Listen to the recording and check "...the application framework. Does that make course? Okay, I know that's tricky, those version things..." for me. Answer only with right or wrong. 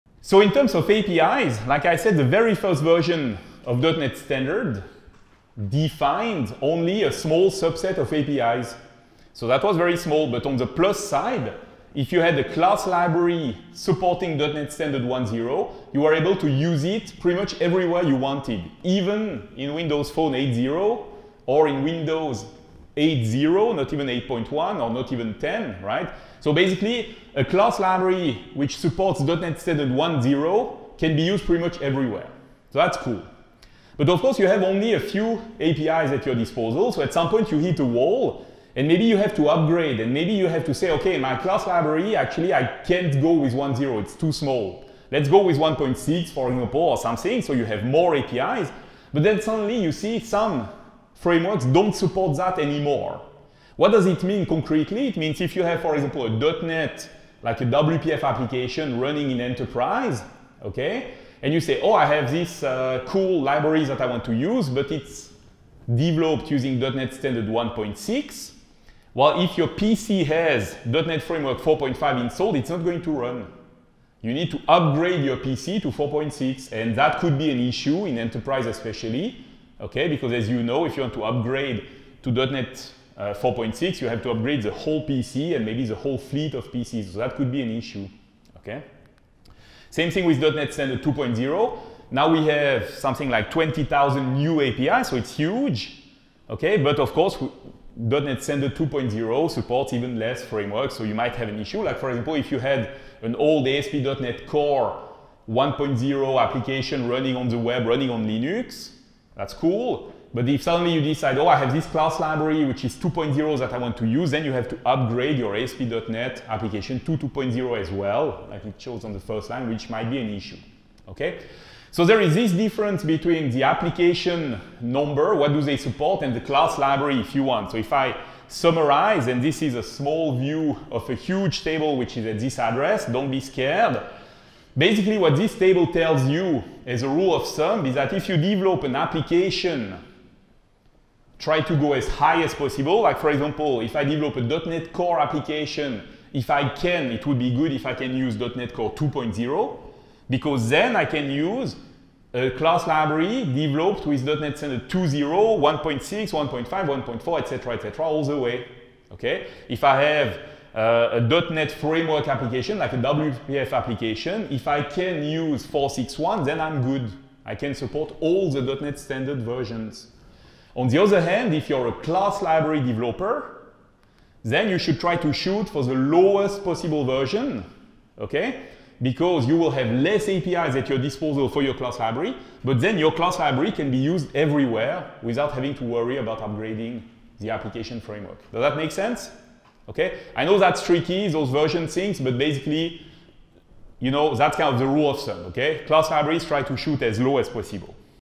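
wrong.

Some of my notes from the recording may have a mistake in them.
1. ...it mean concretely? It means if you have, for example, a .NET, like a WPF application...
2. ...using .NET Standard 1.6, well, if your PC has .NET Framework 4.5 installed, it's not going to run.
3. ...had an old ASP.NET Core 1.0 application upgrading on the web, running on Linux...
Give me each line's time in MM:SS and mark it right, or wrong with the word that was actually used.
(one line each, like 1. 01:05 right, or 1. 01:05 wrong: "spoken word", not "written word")
1. 00:54 right
2. 01:06 right
3. 01:42 wrong: "running", not "upgrading".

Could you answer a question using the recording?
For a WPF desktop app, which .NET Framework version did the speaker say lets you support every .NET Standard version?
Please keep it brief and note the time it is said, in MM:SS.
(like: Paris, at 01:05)
4.6.1, at 02:45.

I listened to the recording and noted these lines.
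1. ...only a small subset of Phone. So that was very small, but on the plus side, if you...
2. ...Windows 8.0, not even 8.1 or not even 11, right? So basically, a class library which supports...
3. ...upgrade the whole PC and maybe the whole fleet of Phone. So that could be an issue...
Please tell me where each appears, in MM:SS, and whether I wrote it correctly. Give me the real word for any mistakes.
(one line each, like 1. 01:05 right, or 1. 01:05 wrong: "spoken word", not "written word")
1. 00:06 wrong: "APIs", not "Phone"
2. 00:21 wrong: "10", not "11"
3. 01:24 wrong: "PCs", not "Phone".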